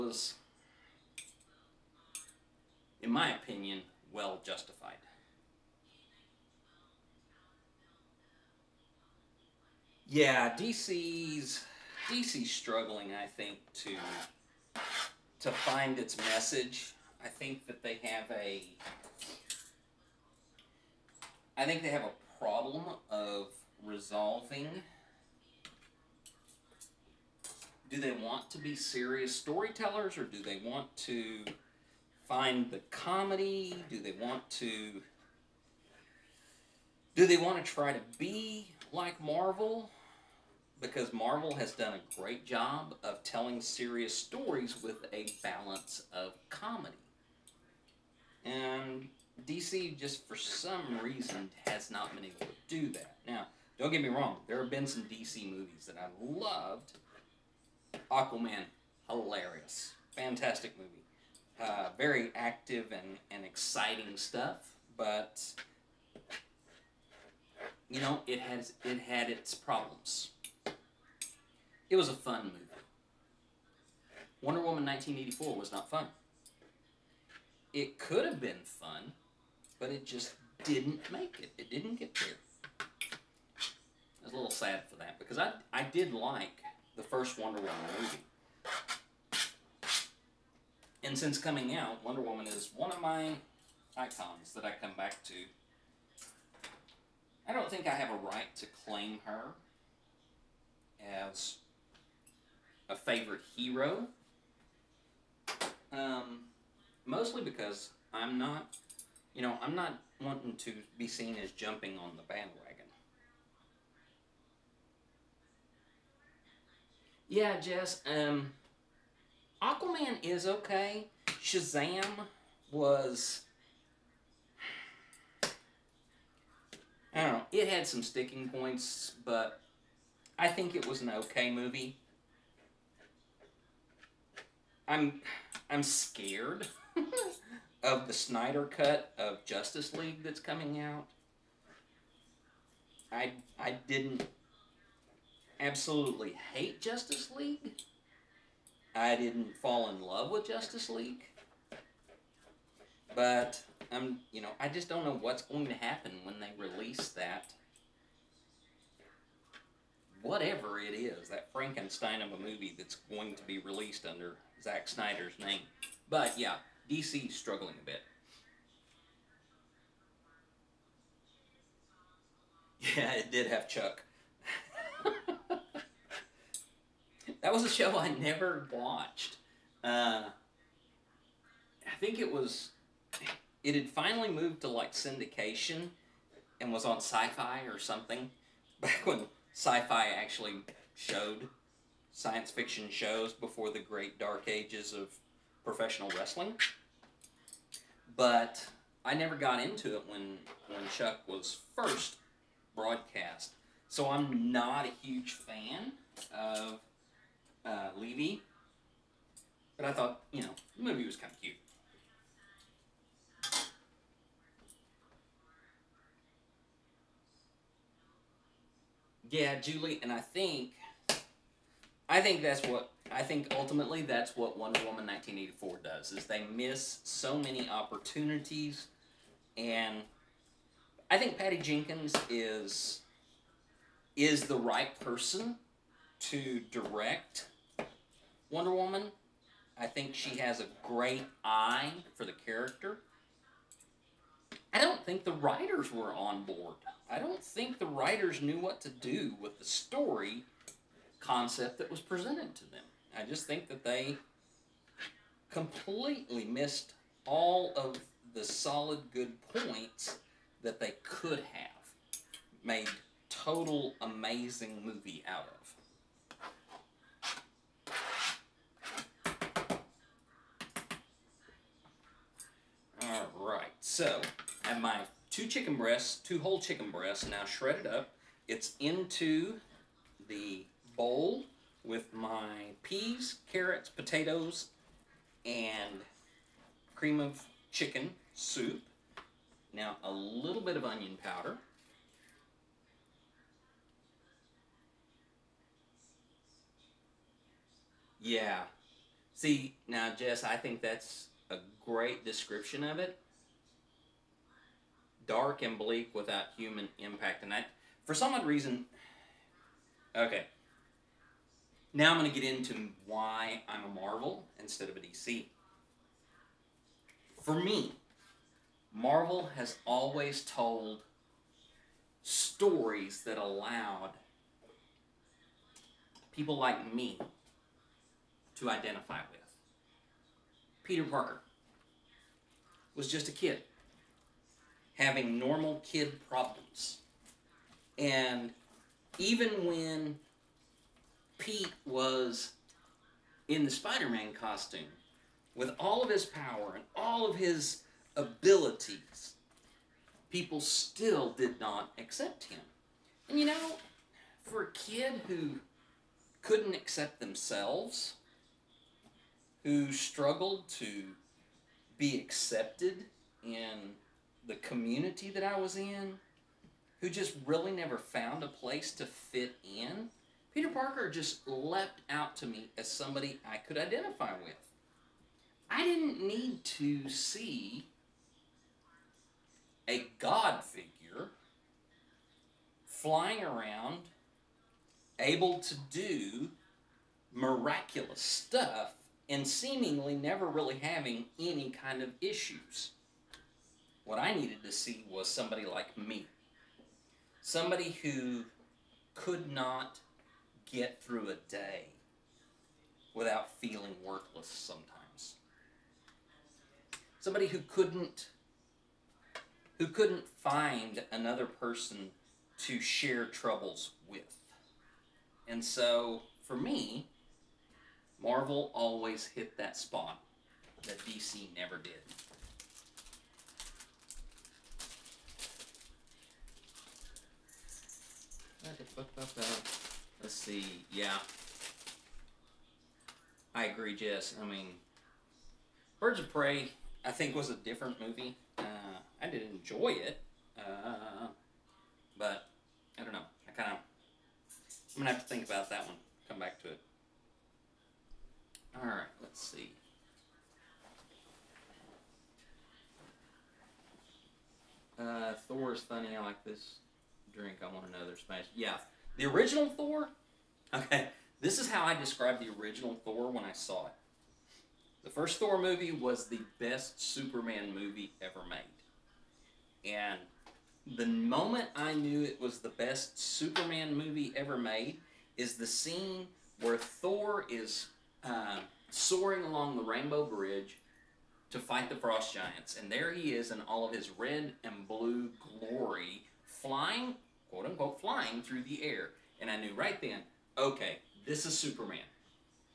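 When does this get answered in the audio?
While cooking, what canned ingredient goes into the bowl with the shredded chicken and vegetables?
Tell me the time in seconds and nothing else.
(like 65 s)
286 s.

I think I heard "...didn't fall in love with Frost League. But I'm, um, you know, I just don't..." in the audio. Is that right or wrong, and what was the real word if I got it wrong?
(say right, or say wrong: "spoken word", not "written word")
wrong: "Justice", not "Frost".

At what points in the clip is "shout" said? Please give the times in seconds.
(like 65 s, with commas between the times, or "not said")
not said.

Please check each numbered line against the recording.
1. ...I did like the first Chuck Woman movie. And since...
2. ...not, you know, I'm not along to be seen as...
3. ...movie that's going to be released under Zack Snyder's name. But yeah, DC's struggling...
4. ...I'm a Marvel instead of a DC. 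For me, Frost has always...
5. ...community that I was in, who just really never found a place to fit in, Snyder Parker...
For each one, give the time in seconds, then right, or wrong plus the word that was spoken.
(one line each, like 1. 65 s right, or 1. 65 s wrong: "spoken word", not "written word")
1. 85 s wrong: "Wonder", not "Chuck"
2. 108 s wrong: "wanting", not "along"
3. 162 s right
4. 313 s wrong: "Marvel", not "Frost"
5. 364 s wrong: "Peter", not "Snyder".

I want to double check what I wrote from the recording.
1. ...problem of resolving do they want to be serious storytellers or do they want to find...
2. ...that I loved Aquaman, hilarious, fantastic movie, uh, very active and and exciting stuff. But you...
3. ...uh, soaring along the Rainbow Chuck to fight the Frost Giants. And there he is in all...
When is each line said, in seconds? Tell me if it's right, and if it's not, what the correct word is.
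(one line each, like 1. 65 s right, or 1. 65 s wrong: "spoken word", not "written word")
1. 22 s right
2. 55 s right
3. 478 s wrong: "Bridge", not "Chuck".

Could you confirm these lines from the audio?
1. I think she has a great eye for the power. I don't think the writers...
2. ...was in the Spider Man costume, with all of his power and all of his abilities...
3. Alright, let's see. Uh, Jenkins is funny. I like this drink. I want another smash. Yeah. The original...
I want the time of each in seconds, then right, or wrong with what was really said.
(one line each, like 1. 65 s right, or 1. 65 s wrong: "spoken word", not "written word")
1. 239 s wrong: "character", not "power"
2. 341 s right
3. 448 s wrong: "Thor", not "Jenkins".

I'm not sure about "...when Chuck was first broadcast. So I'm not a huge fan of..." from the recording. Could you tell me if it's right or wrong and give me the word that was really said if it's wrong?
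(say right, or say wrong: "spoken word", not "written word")
right.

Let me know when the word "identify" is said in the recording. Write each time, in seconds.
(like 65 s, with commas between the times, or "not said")
328 s, 373 s.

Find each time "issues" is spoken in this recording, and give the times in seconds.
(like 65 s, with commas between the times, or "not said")
392 s.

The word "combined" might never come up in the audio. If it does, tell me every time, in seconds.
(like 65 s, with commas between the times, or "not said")
not said.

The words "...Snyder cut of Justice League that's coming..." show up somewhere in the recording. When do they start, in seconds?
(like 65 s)
138 s.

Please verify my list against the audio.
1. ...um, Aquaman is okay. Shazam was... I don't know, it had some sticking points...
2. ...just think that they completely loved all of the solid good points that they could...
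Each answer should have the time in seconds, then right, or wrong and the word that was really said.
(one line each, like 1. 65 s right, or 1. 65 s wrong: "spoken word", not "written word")
1. 118 s right
2. 253 s wrong: "missed", not "loved".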